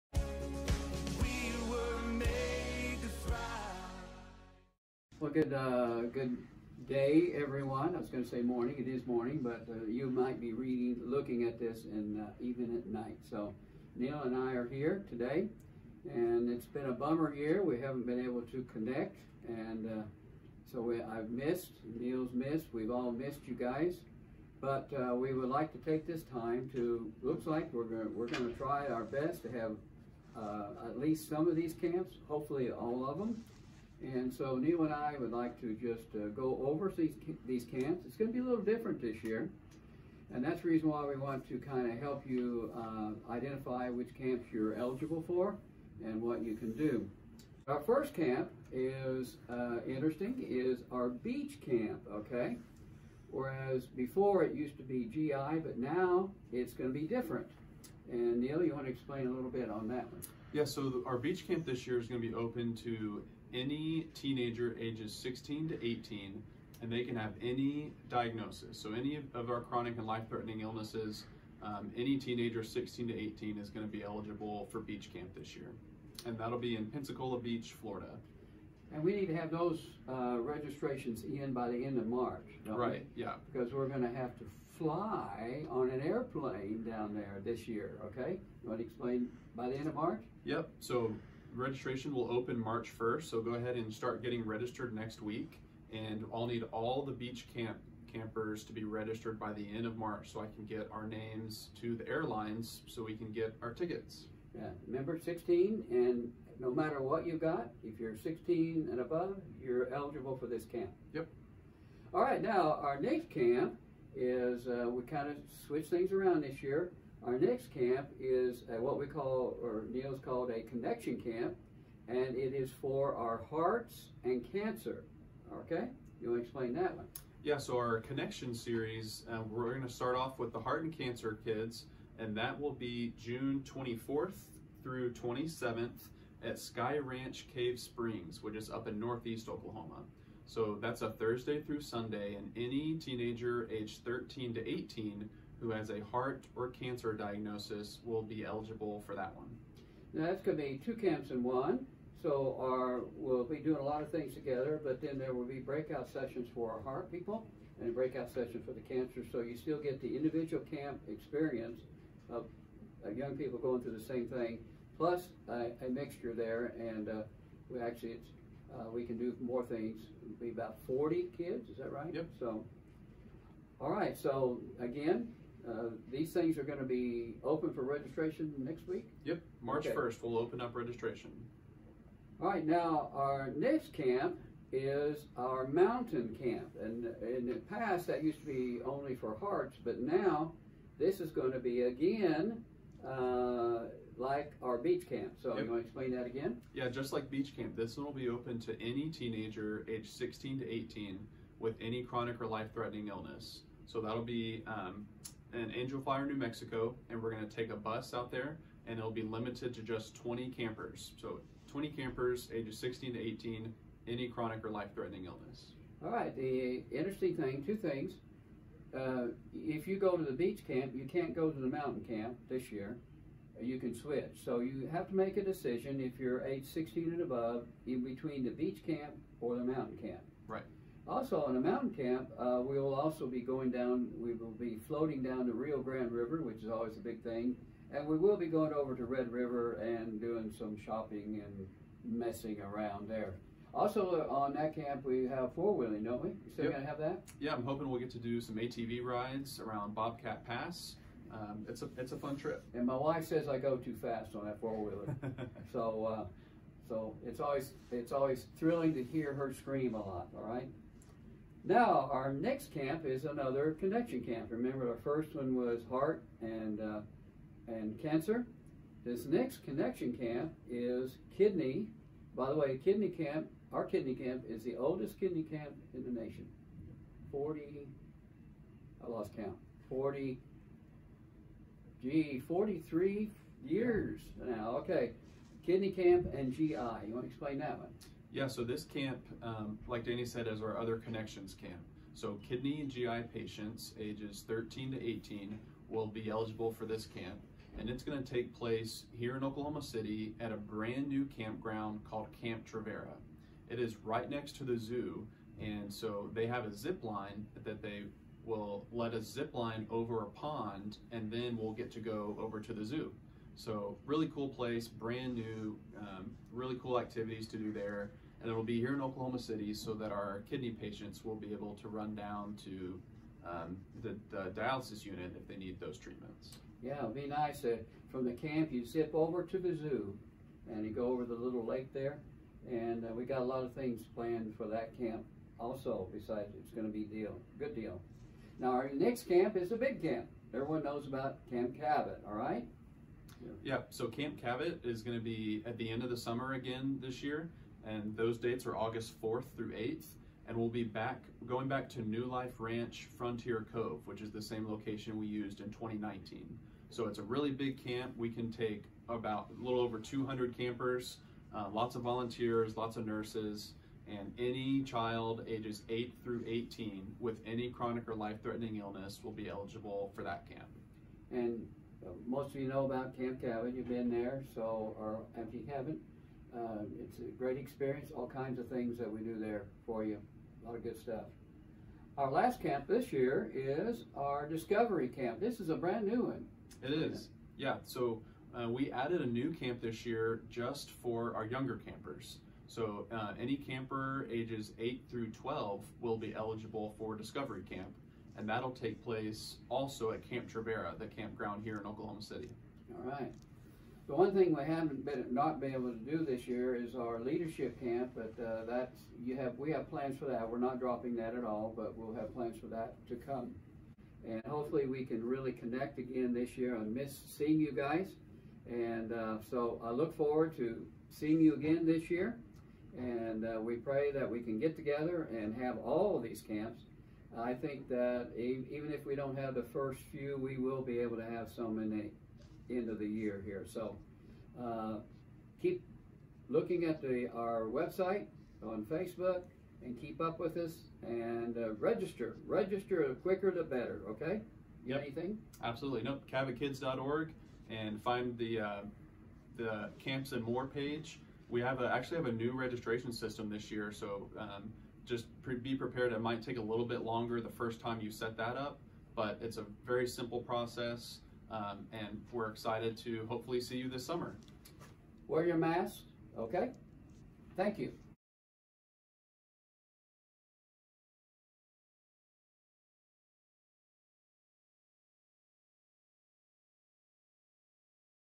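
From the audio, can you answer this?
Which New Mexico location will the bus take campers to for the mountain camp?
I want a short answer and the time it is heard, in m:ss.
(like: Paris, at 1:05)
Angel Fire, at 3:25.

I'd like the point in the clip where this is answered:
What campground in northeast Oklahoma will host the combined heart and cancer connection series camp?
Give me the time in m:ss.
2:16.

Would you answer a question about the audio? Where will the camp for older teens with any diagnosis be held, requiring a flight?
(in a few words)
Pensacola Beach, Florida.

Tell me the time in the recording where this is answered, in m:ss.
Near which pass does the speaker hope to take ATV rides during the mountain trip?
4:09.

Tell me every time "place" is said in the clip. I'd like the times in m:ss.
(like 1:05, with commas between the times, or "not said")
4:58, 5:14, 6:39.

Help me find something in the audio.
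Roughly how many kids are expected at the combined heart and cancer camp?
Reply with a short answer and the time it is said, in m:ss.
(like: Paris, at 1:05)
40, at 2:50.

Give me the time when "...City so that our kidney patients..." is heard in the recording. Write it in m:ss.
5:19.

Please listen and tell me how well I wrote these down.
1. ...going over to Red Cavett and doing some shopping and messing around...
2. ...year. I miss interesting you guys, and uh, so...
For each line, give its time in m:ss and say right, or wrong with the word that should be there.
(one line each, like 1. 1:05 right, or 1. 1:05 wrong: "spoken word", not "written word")
1. 3:58 wrong: "River", not "Cavett"
2. 6:56 wrong: "seeing", not "interesting".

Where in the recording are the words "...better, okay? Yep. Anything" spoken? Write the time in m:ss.
7:23.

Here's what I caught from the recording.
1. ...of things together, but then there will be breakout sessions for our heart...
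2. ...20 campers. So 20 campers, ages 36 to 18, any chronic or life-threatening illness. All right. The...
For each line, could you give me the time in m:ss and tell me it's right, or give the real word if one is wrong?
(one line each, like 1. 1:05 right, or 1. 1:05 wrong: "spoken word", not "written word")
1. 2:34 right
2. 3:30 wrong: "16", not "36".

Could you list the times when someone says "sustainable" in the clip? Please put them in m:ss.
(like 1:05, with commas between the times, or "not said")
not said.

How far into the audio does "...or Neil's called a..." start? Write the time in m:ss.
1:59.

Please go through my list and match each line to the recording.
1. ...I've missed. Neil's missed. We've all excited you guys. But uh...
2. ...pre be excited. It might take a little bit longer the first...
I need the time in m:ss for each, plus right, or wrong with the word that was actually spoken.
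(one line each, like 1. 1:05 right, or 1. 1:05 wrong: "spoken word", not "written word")
1. 0:21 wrong: "missed", not "excited"
2. 7:35 wrong: "prepared", not "excited".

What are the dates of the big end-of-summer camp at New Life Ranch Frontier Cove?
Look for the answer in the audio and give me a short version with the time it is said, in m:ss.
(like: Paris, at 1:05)
August 4-8, at 5:48.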